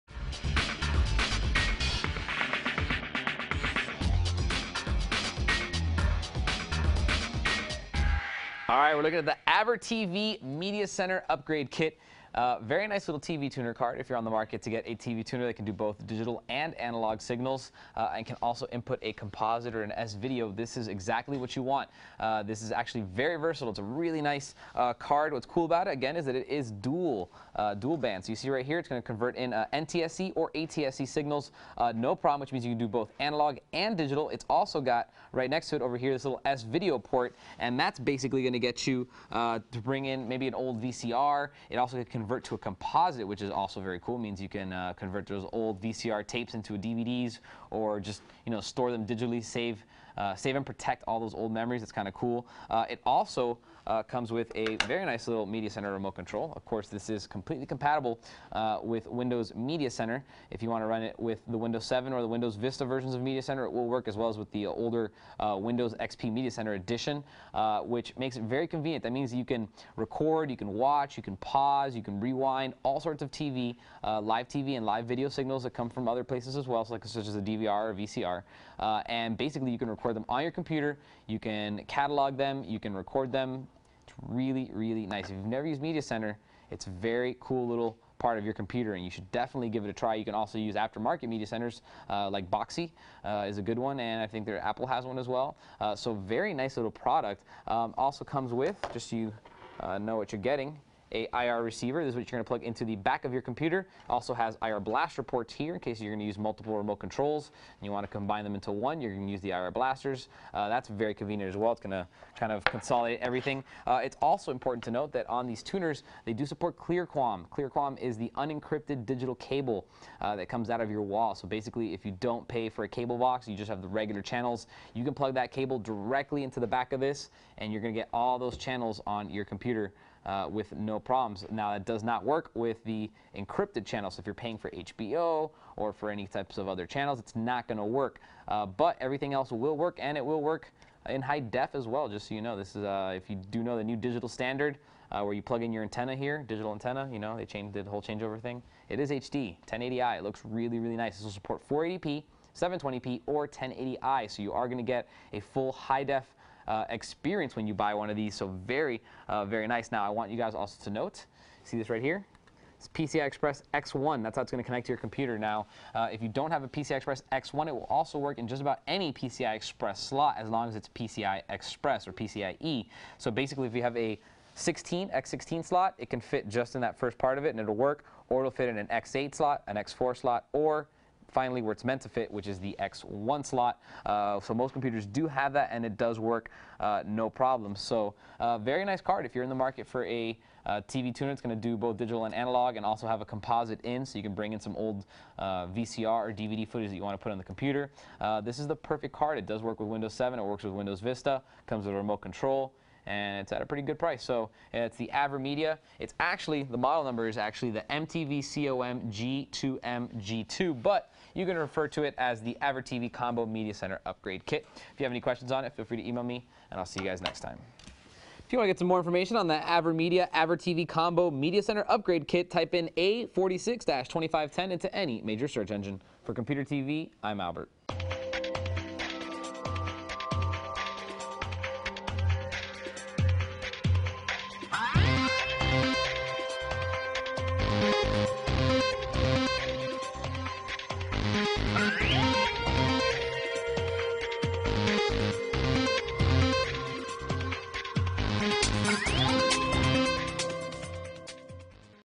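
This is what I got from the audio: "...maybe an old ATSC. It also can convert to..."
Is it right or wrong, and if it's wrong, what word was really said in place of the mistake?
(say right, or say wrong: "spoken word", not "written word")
wrong: "VCR", not "ATSC".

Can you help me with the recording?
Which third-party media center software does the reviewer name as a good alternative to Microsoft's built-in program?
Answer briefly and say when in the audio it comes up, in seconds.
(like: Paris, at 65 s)
Boxee, at 92 s.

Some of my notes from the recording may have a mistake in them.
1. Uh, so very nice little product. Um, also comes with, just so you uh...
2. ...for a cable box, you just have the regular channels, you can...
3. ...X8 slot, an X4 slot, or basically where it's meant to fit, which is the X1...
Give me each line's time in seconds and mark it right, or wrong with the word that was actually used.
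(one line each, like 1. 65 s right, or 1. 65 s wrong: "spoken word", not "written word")
1. 95 s right
2. 122 s right
3. 178 s wrong: "finally", not "basically".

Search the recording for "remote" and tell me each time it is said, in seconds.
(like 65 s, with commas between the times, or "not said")
55 s, 106 s, 201 s.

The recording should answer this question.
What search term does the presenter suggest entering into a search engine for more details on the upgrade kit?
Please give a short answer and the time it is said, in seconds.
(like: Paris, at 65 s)
A46-2510, at 222 s.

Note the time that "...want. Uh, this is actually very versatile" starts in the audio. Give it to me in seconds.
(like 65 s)
21 s.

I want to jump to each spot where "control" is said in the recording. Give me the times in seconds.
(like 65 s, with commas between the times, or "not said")
56 s, 106 s, 202 s.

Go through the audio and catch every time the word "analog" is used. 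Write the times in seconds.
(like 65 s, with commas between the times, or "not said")
16 s, 33 s, 192 s.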